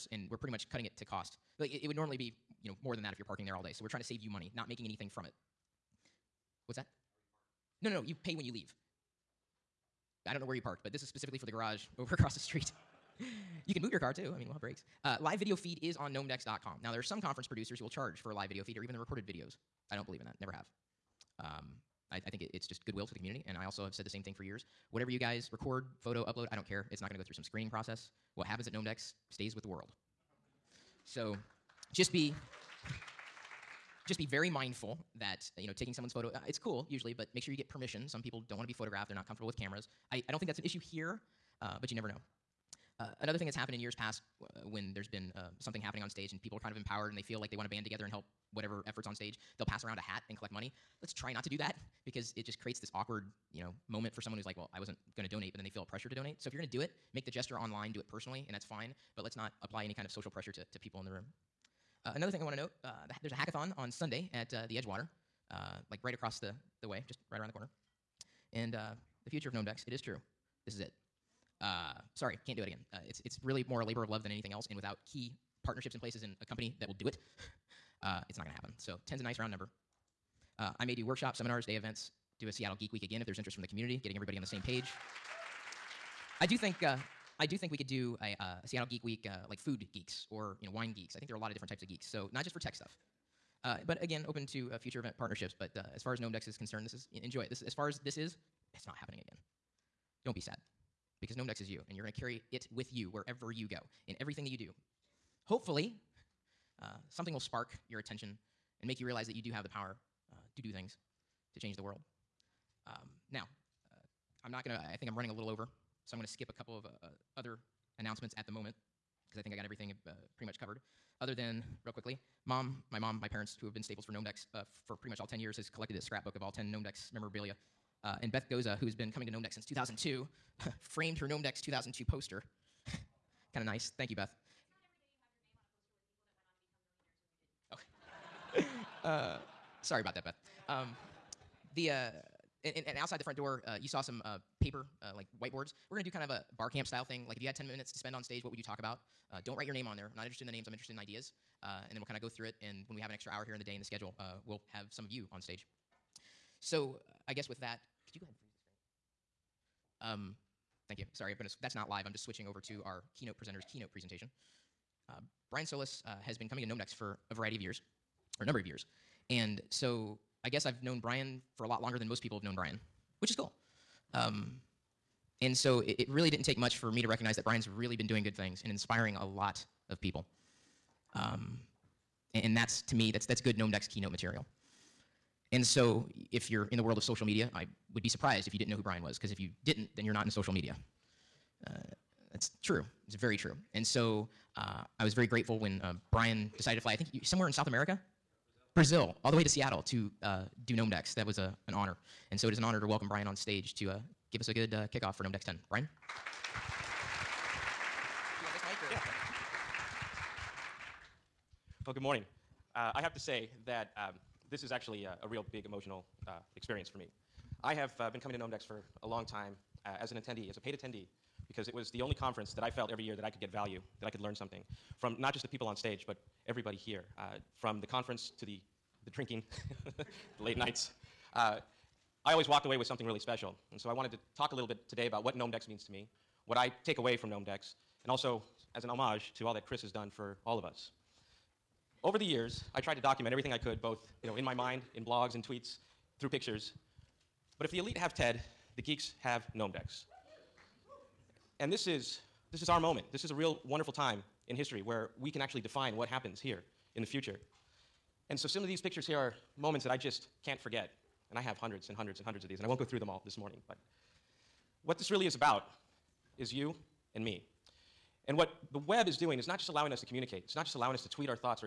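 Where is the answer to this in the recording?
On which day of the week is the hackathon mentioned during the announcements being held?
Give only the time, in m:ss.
1:03.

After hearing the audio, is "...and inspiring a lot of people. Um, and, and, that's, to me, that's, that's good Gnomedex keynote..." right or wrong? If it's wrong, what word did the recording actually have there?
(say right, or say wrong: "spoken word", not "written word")
right.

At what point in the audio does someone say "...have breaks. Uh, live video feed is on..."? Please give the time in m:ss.
0:14.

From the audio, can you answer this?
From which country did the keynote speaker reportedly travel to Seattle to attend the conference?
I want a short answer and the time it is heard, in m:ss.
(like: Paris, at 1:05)
Brazil, at 3:18.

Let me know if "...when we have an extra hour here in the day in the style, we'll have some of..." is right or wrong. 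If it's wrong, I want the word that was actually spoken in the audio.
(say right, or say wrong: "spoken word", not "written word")
wrong: "schedule", not "style".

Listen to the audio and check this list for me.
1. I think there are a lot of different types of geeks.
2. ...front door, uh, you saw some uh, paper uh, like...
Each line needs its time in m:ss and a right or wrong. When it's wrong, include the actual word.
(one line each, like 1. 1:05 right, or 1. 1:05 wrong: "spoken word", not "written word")
1. 1:31 right
2. 2:23 right.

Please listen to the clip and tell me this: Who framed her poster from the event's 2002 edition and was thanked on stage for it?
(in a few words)
Beth Goza.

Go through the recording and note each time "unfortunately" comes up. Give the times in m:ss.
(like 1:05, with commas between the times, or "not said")
not said.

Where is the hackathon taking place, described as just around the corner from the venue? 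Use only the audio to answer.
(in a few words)
the Edgewater.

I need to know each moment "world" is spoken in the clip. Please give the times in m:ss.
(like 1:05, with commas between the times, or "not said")
0:29, 1:51, 3:06.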